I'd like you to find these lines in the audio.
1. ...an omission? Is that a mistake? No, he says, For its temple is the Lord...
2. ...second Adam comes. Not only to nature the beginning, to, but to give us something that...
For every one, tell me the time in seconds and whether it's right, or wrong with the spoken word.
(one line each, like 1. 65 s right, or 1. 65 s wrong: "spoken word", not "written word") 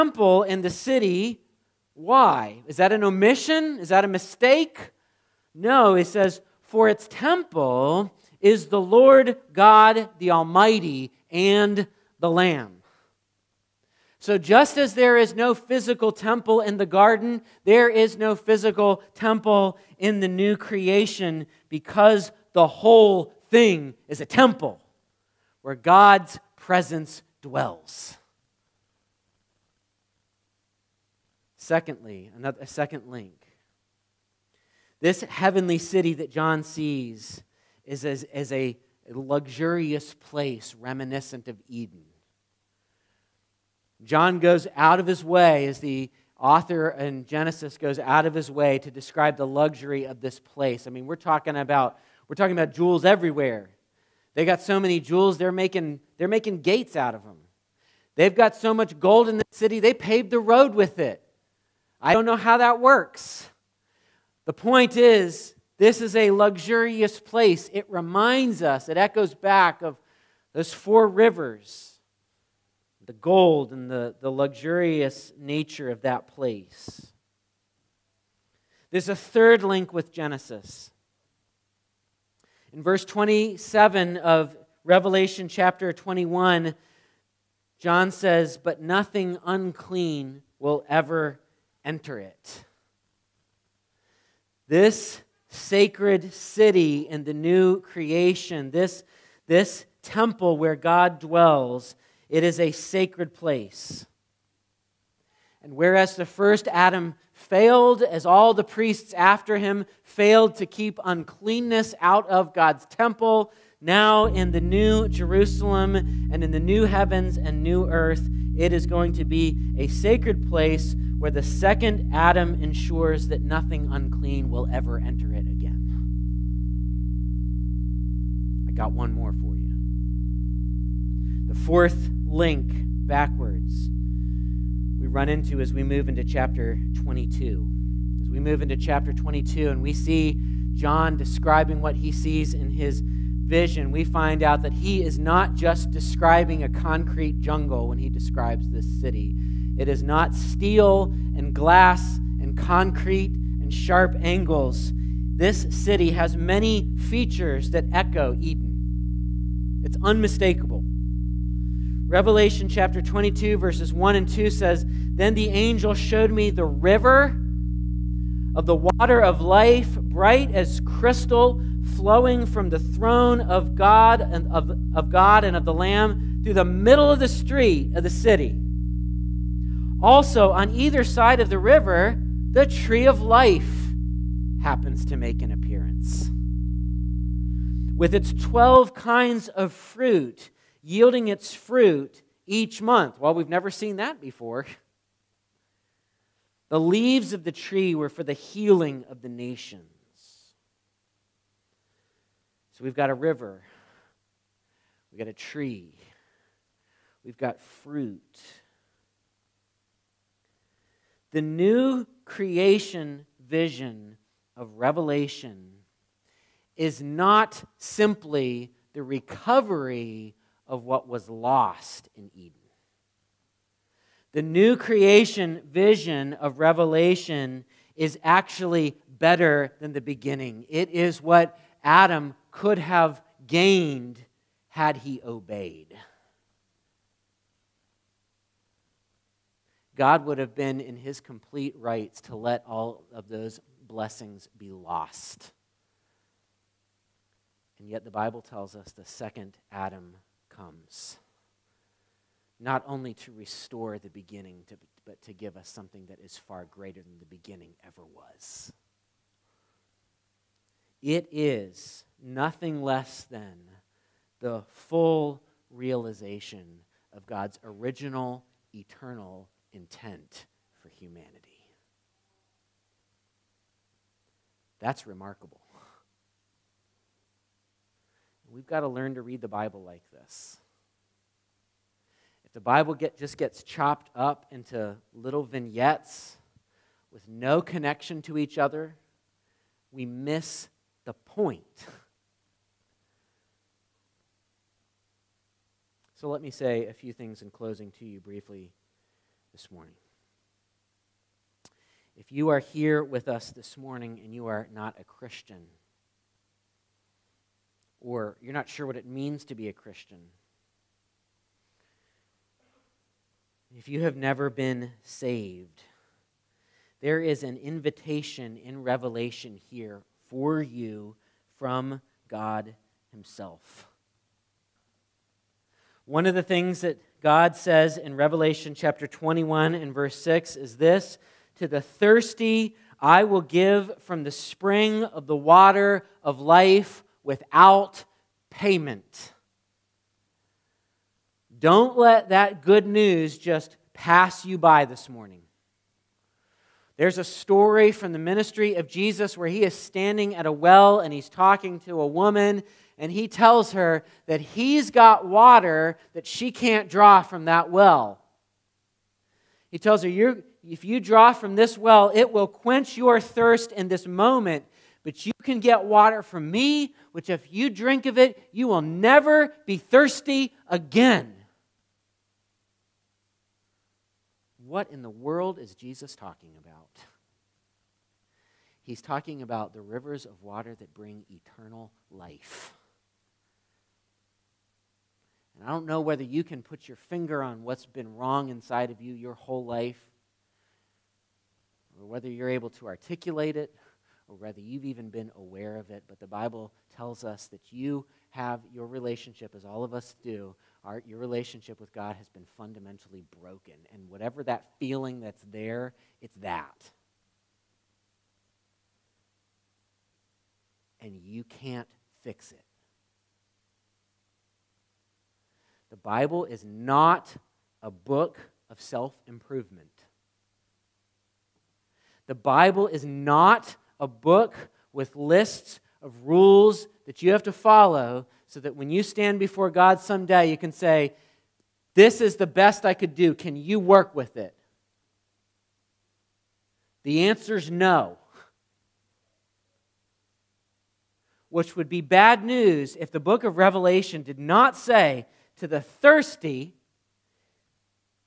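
1. 2 s right
2. 249 s wrong: "restore", not "nature".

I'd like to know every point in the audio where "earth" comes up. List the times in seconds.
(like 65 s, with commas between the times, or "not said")
117 s.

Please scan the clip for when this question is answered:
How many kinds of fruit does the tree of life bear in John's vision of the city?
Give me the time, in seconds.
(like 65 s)
188 s.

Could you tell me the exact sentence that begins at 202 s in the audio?
So we've got a river, we've got a tree, we've got fruit.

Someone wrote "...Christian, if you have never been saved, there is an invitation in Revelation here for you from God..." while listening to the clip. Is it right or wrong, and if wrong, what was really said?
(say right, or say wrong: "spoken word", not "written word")
right.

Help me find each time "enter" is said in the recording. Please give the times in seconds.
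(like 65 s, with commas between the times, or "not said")
91 s, 125 s.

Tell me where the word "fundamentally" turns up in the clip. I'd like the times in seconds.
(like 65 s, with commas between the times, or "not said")
402 s.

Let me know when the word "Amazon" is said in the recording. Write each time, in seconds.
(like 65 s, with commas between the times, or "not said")
not said.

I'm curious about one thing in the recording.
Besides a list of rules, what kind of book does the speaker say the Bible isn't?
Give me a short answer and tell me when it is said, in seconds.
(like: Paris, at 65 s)
Self improvement, at 418 s.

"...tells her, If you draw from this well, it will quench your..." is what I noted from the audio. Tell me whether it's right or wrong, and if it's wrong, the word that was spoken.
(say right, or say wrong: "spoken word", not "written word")
right.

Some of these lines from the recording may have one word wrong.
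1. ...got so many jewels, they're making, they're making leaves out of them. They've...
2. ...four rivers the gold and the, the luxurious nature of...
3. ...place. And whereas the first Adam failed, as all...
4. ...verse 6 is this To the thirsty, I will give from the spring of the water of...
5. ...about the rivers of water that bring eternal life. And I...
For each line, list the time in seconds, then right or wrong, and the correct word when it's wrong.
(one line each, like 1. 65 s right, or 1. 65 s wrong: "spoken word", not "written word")
1. 54 s wrong: "gates", not "leaves"
2. 70 s right
3. 103 s right
4. 329 s right
5. 379 s right.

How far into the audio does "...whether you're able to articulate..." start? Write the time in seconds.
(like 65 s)
392 s.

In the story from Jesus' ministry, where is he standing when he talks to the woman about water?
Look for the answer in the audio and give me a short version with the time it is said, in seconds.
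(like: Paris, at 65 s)
At a well, at 350 s.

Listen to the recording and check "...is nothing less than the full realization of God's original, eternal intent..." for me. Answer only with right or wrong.
right.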